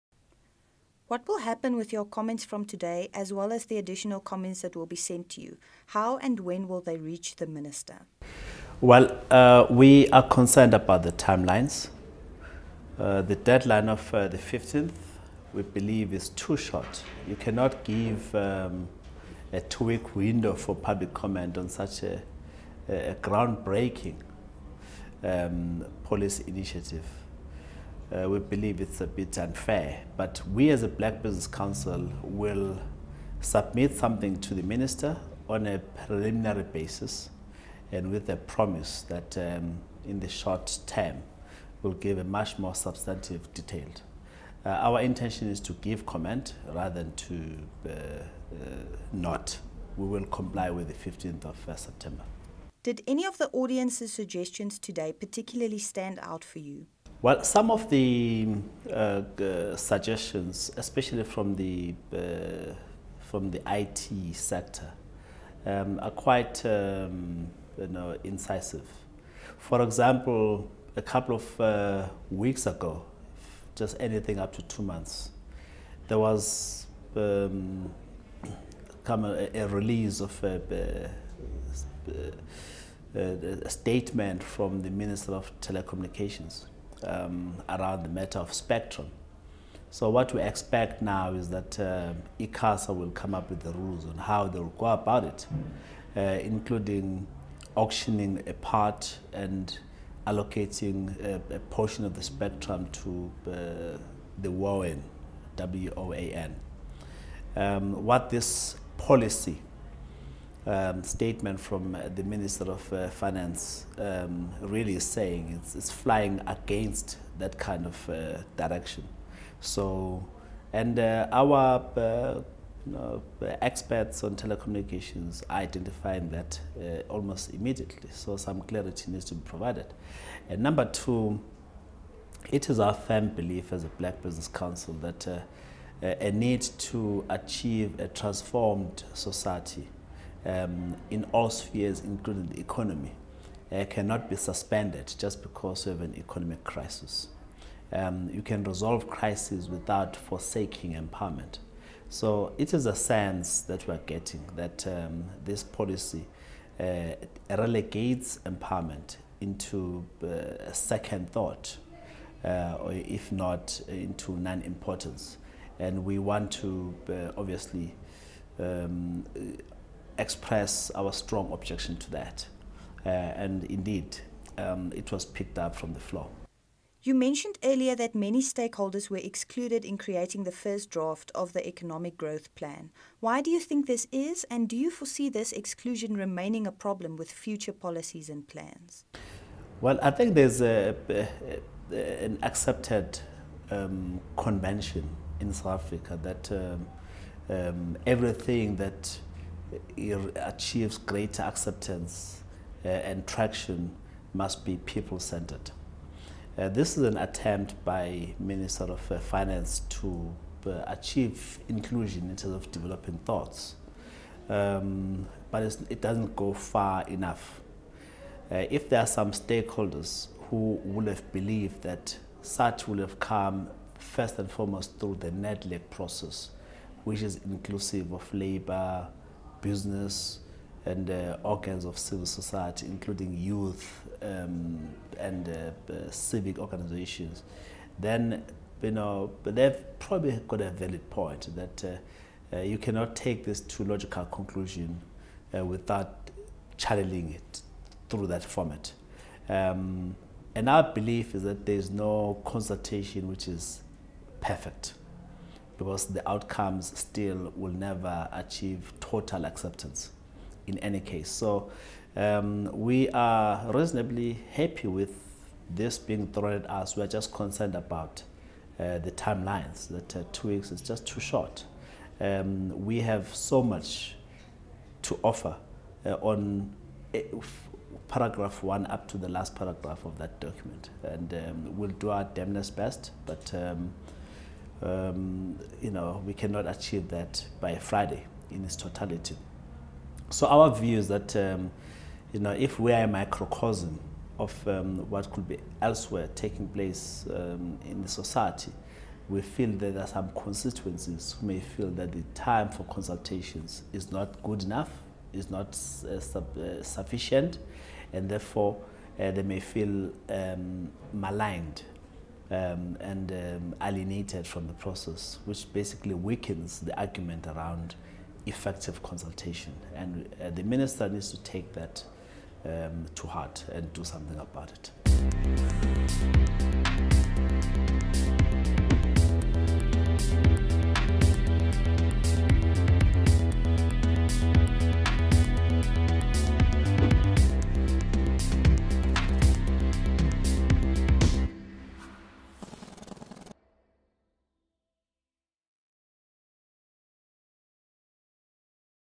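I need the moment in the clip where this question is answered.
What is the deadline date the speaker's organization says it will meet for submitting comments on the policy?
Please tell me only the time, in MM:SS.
00:51.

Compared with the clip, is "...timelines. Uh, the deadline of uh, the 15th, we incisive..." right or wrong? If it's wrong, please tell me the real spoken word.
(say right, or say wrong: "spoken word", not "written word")
wrong: "believe", not "incisive".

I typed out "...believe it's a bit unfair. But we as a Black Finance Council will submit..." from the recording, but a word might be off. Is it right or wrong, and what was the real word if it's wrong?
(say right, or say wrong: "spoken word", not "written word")
wrong: "Business", not "Finance".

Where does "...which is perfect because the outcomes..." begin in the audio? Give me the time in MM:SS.
04:13.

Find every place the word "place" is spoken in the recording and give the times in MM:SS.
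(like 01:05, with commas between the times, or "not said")
04:56.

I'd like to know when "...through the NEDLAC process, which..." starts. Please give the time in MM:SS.
03:44.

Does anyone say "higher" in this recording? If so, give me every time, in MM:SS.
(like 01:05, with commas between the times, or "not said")
not said.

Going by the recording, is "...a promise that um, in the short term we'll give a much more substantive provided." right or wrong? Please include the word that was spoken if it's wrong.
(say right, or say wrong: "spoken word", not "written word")
wrong: "detailed", not "provided".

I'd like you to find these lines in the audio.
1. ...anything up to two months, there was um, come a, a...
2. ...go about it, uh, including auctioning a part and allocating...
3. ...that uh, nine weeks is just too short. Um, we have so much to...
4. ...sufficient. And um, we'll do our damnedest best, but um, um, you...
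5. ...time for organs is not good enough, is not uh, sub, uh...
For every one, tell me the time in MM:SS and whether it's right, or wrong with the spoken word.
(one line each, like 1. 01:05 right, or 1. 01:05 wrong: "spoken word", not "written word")
1. 01:13 right
2. 01:34 right
3. 04:29 wrong: "two", not "nine"
4. 04:40 wrong: "document", not "sufficient"
5. 05:02 wrong: "consultations", not "organs".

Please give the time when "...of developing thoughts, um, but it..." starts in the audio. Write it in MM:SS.
03:32.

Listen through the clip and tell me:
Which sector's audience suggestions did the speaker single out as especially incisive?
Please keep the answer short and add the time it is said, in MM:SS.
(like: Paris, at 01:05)
IT sector, at 01:03.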